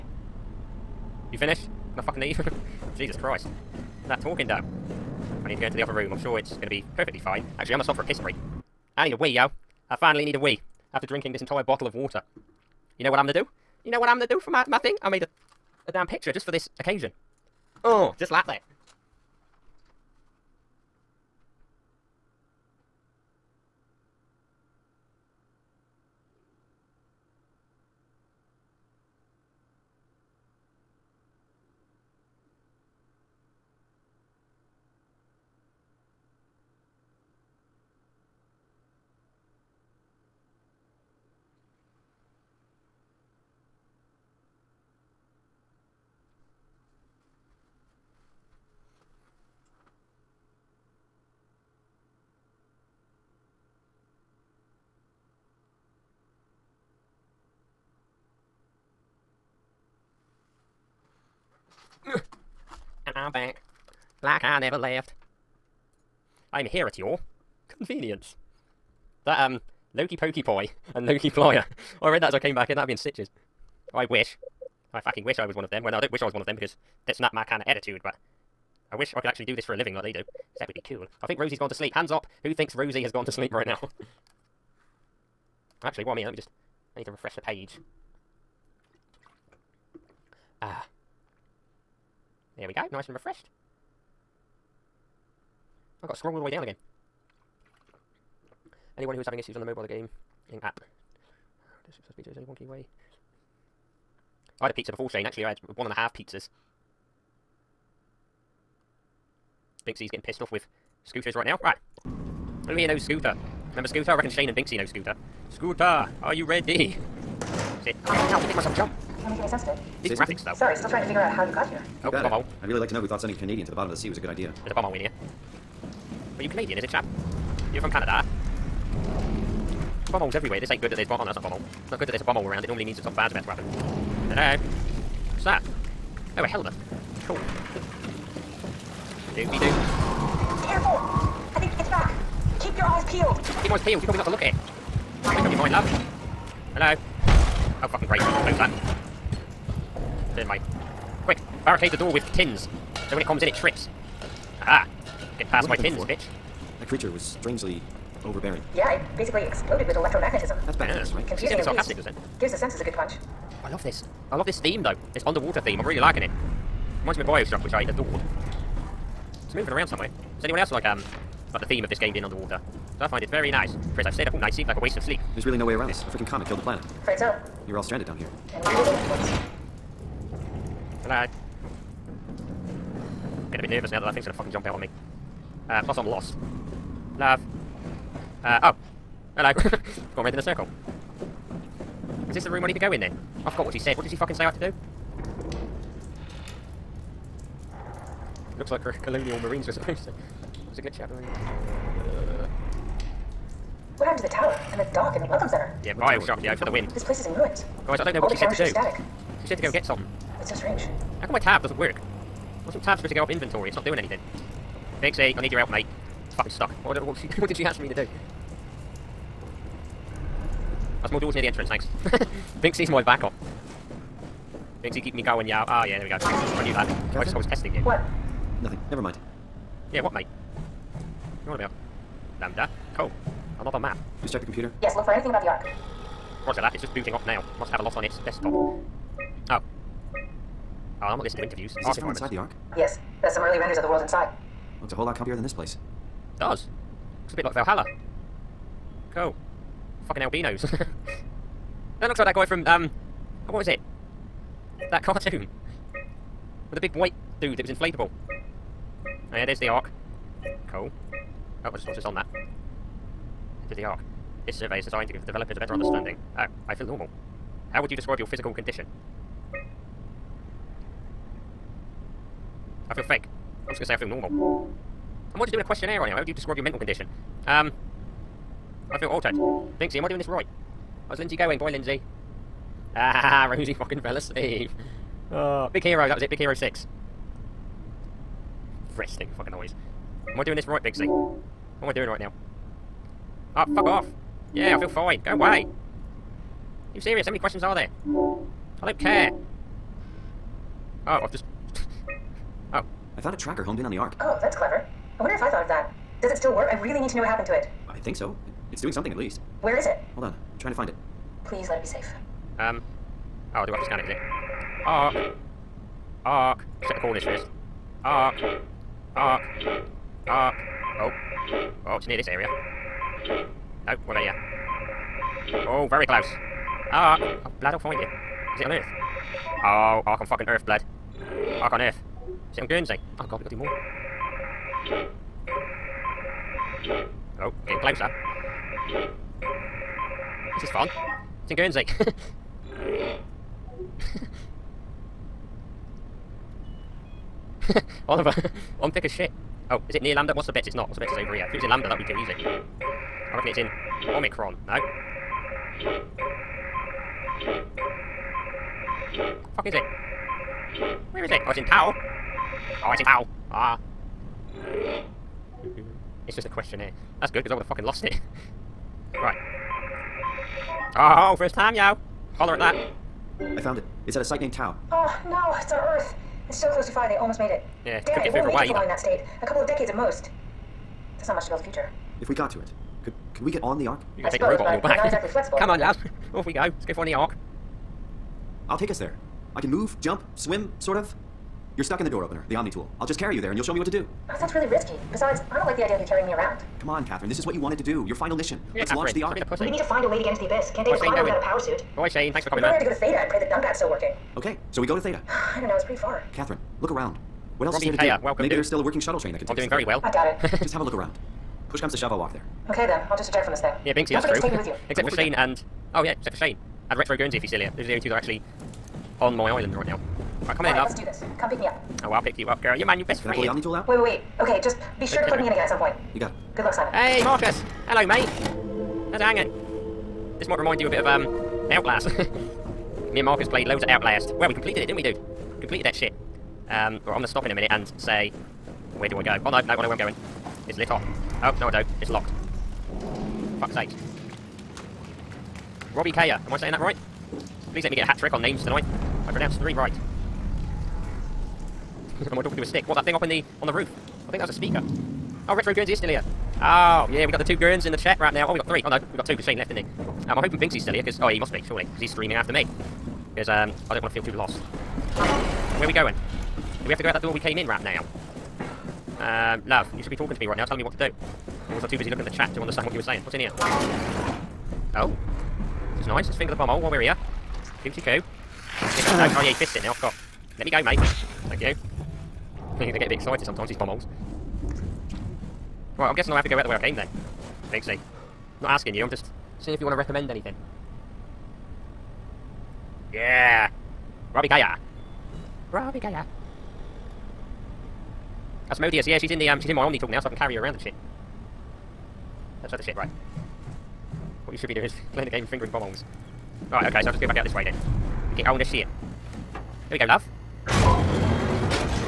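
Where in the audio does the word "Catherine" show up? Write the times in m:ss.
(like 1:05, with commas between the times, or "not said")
6:37, 6:46.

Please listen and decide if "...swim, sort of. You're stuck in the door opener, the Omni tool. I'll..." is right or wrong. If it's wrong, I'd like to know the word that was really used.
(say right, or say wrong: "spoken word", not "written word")
right.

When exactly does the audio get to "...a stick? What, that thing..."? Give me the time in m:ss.
7:32.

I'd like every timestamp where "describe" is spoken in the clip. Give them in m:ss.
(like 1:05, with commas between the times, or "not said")
4:27, 4:36.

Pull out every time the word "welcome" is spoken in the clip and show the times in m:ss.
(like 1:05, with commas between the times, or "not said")
3:25, 6:48.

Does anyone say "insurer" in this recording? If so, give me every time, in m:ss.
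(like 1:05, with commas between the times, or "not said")
not said.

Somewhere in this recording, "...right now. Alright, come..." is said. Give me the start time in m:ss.
6:59.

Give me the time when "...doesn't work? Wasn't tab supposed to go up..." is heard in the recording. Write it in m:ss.
3:31.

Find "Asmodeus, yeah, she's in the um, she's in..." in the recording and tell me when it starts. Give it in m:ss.
8:18.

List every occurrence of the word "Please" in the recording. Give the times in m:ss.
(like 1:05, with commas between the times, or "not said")
5:11, 7:27.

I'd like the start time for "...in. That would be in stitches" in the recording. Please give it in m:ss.
1:12.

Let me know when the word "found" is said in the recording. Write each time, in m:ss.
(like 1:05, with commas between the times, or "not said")
5:03, 6:13.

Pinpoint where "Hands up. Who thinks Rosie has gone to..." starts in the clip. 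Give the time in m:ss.
1:21.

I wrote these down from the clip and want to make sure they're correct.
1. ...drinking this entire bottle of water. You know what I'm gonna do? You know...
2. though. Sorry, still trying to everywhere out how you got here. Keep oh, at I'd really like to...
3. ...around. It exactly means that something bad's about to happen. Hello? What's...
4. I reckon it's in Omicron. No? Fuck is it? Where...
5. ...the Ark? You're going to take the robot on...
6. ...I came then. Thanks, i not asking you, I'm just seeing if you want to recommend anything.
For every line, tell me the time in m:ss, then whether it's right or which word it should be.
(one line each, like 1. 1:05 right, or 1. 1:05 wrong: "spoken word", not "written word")
1. 0:11 right
2. 2:00 wrong: "figure", not "everywhere"
3. 2:12 wrong: "normally", not "exactly"
4. 5:53 right
5. 6:23 right
6. 8:06 right.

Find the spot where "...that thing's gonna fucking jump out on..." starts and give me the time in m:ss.
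3:04.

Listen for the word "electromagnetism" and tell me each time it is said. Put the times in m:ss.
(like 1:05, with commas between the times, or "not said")
2:39.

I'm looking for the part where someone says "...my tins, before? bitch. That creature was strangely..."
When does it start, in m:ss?
2:35.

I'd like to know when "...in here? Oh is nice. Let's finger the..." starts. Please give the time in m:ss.
7:53.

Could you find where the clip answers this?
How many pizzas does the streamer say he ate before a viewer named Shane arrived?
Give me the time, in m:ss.
1:45.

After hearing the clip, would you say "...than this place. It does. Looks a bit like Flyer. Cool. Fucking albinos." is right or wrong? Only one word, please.
wrong.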